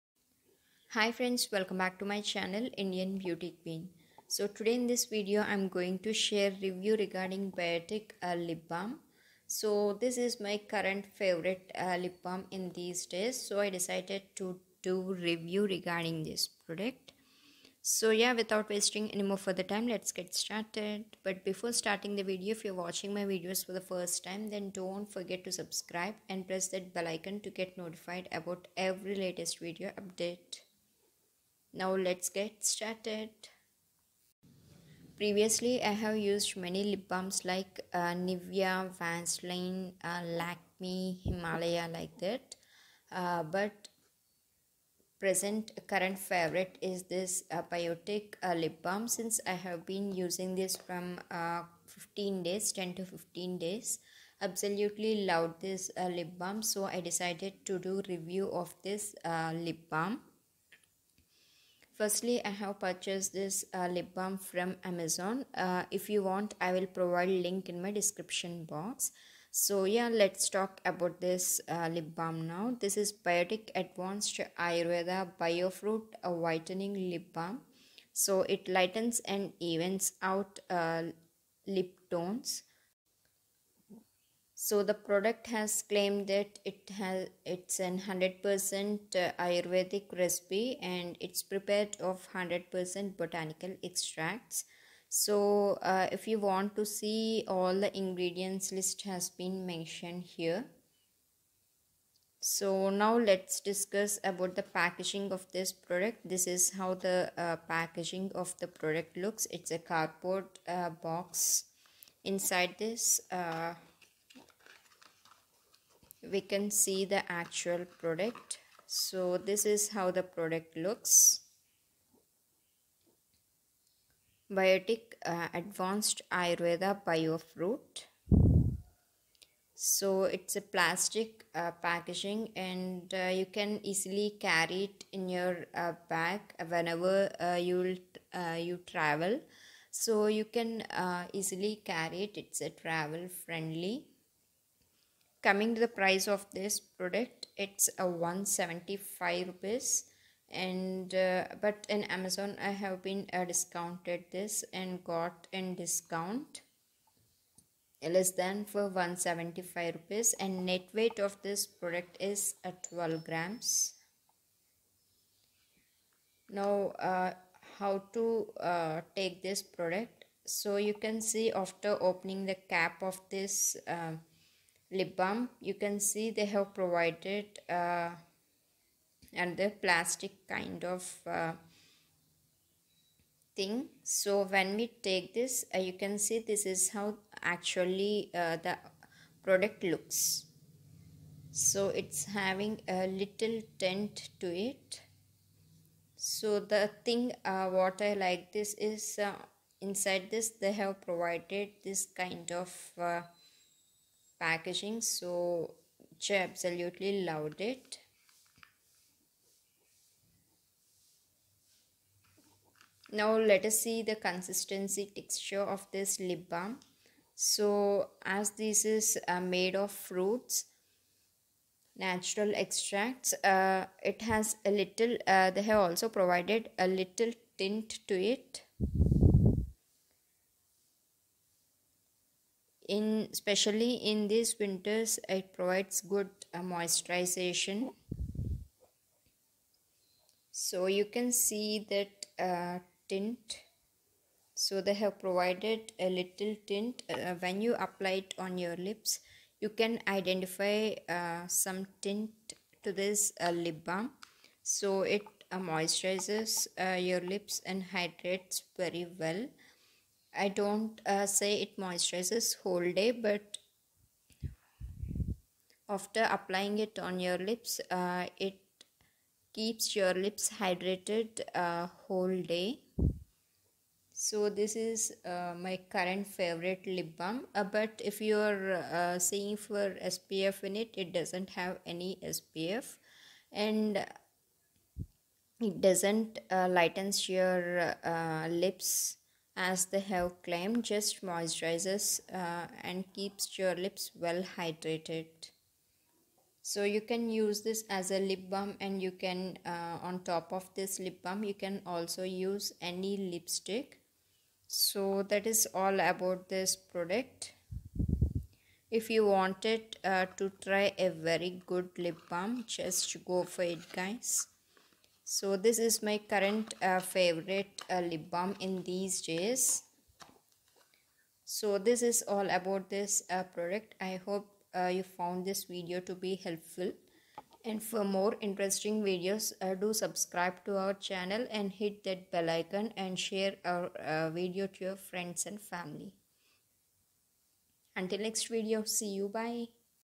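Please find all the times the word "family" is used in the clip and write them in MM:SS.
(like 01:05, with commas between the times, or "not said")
05:35.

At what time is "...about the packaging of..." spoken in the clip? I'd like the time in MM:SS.
01:44.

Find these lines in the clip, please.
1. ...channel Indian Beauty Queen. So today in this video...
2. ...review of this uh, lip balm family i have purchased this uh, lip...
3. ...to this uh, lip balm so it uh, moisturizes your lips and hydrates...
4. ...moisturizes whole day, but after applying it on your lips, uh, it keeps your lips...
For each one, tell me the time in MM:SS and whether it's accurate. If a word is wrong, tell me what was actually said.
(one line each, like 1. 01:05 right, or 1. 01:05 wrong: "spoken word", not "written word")
1. 00:02 right
2. 00:58 wrong: "firstly", not "family"
3. 04:12 right
4. 04:21 right.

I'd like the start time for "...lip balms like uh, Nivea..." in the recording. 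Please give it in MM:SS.
00:36.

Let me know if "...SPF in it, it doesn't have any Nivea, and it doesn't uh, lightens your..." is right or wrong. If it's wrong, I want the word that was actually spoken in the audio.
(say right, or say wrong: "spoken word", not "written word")
wrong: "SPF", not "Nivea".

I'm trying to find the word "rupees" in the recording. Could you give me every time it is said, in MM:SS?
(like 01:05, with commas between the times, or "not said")
02:29, 02:39.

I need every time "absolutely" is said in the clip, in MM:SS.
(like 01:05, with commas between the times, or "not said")
00:54, 03:26.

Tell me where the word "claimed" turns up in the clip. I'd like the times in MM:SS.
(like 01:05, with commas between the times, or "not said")
01:25, 04:50.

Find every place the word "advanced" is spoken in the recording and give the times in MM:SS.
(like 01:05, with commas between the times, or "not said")
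01:13, 02:05.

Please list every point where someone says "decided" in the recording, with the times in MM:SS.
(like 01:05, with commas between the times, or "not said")
00:13, 00:57.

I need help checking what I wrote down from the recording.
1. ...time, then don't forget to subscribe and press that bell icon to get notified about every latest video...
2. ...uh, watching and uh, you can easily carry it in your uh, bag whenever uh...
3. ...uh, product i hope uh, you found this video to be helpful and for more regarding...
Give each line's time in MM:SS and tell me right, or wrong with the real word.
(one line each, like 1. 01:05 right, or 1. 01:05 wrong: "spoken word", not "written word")
1. 00:24 right
2. 02:11 wrong: "packaging", not "watching"
3. 05:23 wrong: "interesting", not "regarding".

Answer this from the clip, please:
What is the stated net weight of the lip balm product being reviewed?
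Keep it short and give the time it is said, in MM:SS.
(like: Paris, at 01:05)
12 grams, at 02:42.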